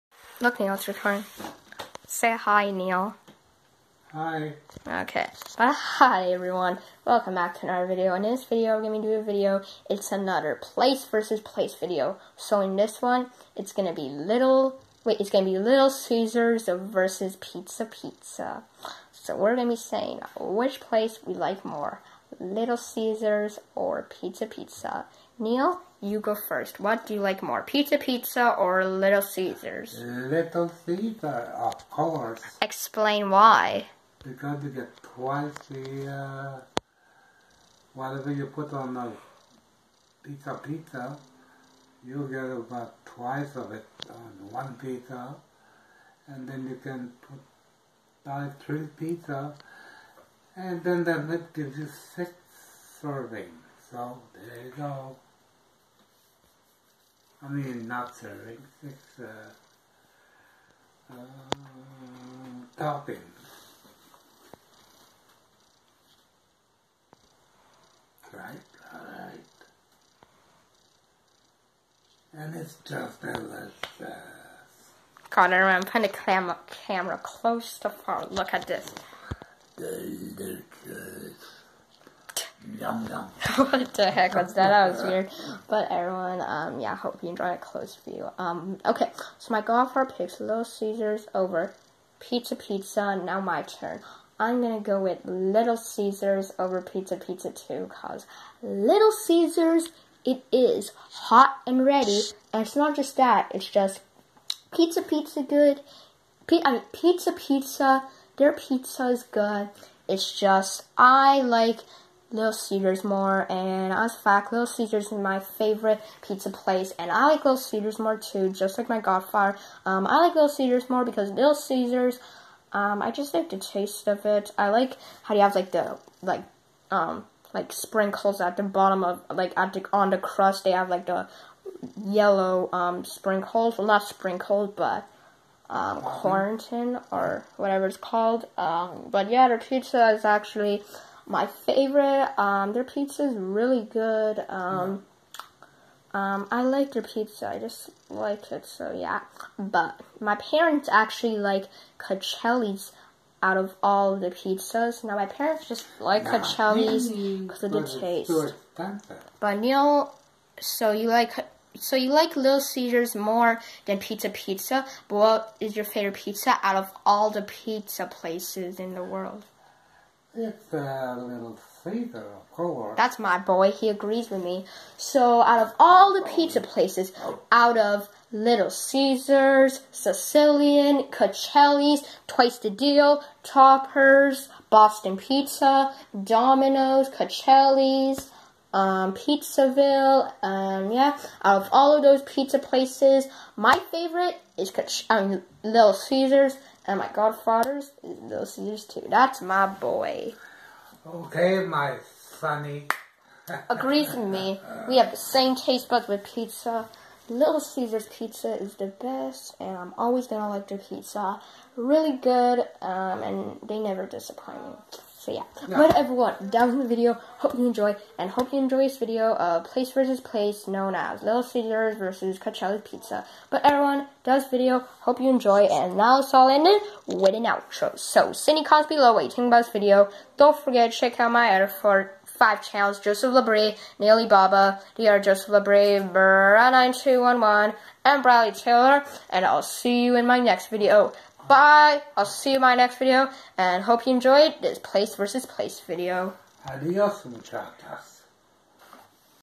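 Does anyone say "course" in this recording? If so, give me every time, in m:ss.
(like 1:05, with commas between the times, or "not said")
0:31, 2:52.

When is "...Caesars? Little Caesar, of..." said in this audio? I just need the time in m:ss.
0:29.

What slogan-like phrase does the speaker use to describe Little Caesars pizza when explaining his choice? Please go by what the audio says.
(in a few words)
hot and ready.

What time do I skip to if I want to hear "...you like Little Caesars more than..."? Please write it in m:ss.
2:41.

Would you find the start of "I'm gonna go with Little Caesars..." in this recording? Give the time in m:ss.
1:34.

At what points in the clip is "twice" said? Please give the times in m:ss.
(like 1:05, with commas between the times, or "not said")
0:35, 0:43, 3:02.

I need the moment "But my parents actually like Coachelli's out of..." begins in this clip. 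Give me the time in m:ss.
2:29.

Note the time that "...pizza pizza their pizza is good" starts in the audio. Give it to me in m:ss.
1:46.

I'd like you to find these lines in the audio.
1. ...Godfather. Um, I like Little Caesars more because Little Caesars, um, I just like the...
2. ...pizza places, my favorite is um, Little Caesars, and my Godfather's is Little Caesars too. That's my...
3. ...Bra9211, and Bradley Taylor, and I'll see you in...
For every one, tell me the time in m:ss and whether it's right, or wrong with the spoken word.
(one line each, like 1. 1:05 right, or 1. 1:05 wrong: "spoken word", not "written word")
1. 1:58 right
2. 3:12 right
3. 3:56 right.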